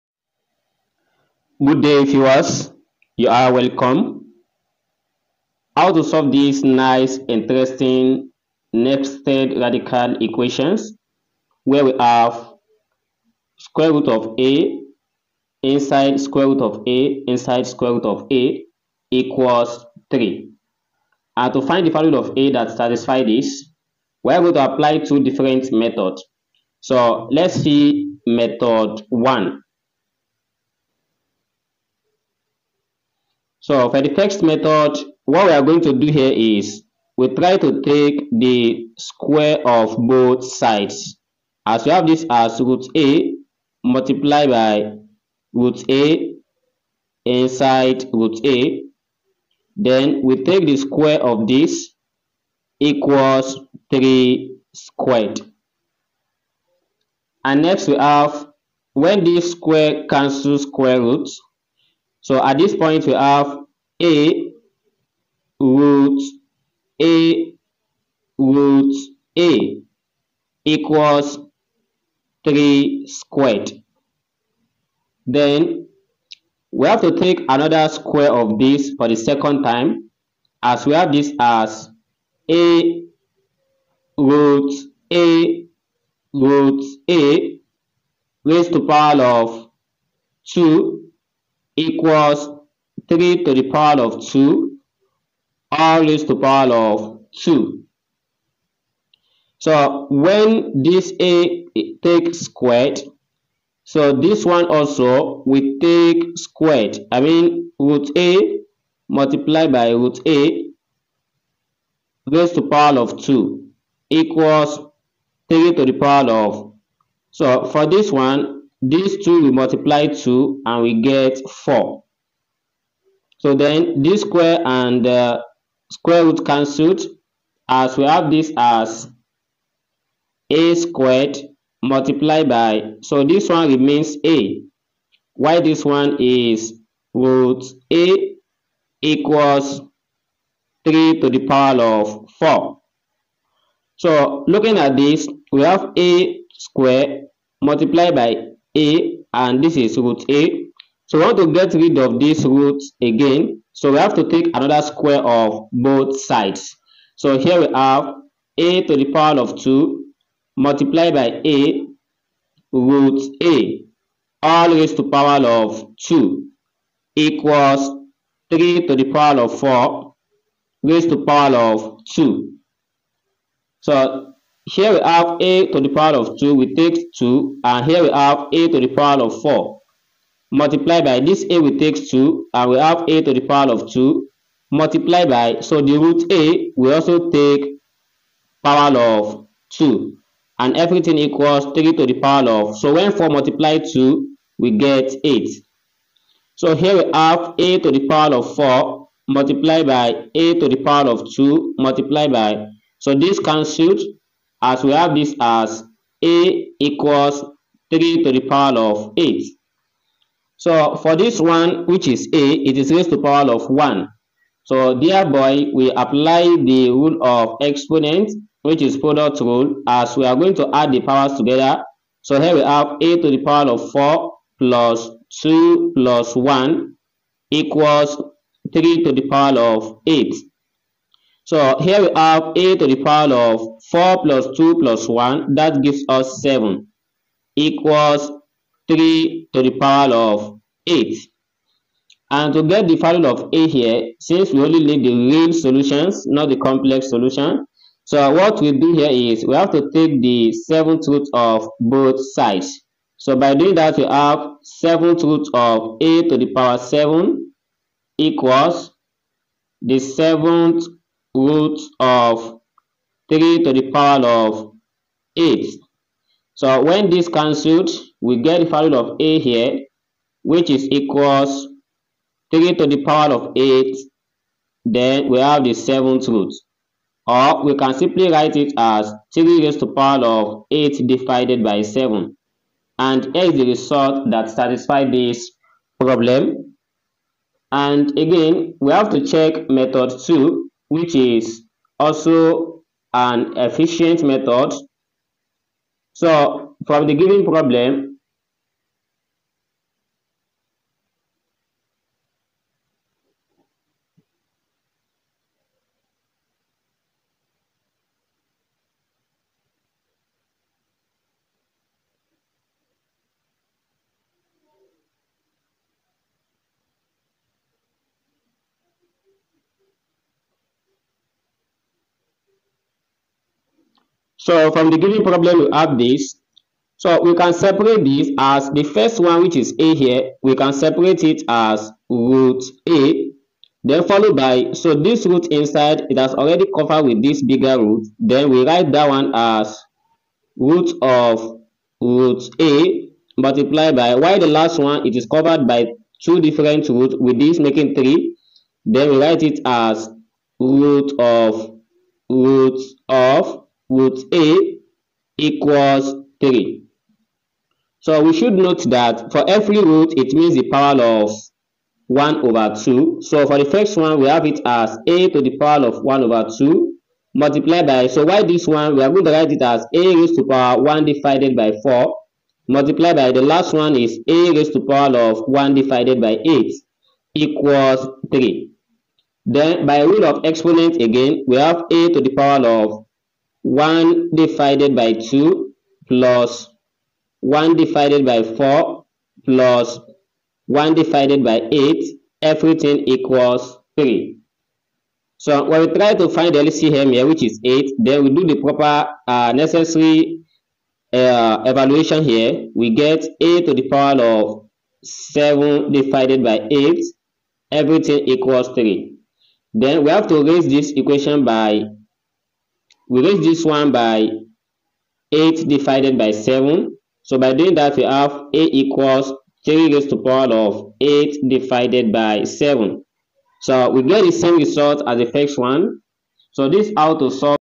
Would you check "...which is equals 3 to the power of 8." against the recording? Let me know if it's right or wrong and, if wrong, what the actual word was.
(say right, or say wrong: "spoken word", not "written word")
right.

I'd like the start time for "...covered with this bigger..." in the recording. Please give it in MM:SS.
05:36.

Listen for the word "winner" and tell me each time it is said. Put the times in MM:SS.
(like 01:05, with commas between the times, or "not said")
not said.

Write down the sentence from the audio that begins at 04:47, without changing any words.
And again, we have to check method 2 which is also an efficient method.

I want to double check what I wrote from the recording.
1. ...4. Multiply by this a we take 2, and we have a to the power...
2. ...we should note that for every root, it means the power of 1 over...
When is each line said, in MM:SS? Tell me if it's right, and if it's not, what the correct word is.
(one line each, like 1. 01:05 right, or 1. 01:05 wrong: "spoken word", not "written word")
1. 02:59 right
2. 05:58 right.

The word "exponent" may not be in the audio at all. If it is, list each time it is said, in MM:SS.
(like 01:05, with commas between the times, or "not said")
03:37, 06:20.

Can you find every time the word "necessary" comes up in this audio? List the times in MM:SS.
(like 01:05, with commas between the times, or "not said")
06:39.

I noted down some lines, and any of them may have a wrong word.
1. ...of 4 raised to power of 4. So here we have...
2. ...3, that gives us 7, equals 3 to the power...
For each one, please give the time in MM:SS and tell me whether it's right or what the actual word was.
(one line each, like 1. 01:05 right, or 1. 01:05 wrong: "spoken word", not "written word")
1. 02:49 wrong: "2", not "4"
2. 03:55 wrong: "1", not "3".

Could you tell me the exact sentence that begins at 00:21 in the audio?
And to find the value of a that satisfies this, we are going to apply two different methods.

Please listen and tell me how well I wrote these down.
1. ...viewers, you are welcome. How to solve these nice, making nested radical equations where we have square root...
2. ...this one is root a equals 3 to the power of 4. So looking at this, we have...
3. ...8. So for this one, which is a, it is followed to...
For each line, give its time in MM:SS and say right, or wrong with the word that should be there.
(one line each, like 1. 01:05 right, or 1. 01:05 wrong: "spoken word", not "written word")
1. 00:02 wrong: "interesting", not "making"
2. 02:15 right
3. 03:29 wrong: "raised", not "followed".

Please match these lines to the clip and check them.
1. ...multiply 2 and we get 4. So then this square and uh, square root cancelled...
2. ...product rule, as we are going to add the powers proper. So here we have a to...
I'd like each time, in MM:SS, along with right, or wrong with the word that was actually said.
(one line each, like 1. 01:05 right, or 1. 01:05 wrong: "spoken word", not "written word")
1. 01:59 right
2. 03:38 wrong: "together", not "proper".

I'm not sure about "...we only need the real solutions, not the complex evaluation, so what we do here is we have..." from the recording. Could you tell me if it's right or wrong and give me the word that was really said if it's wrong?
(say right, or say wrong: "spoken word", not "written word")
wrong: "solution", not "evaluation".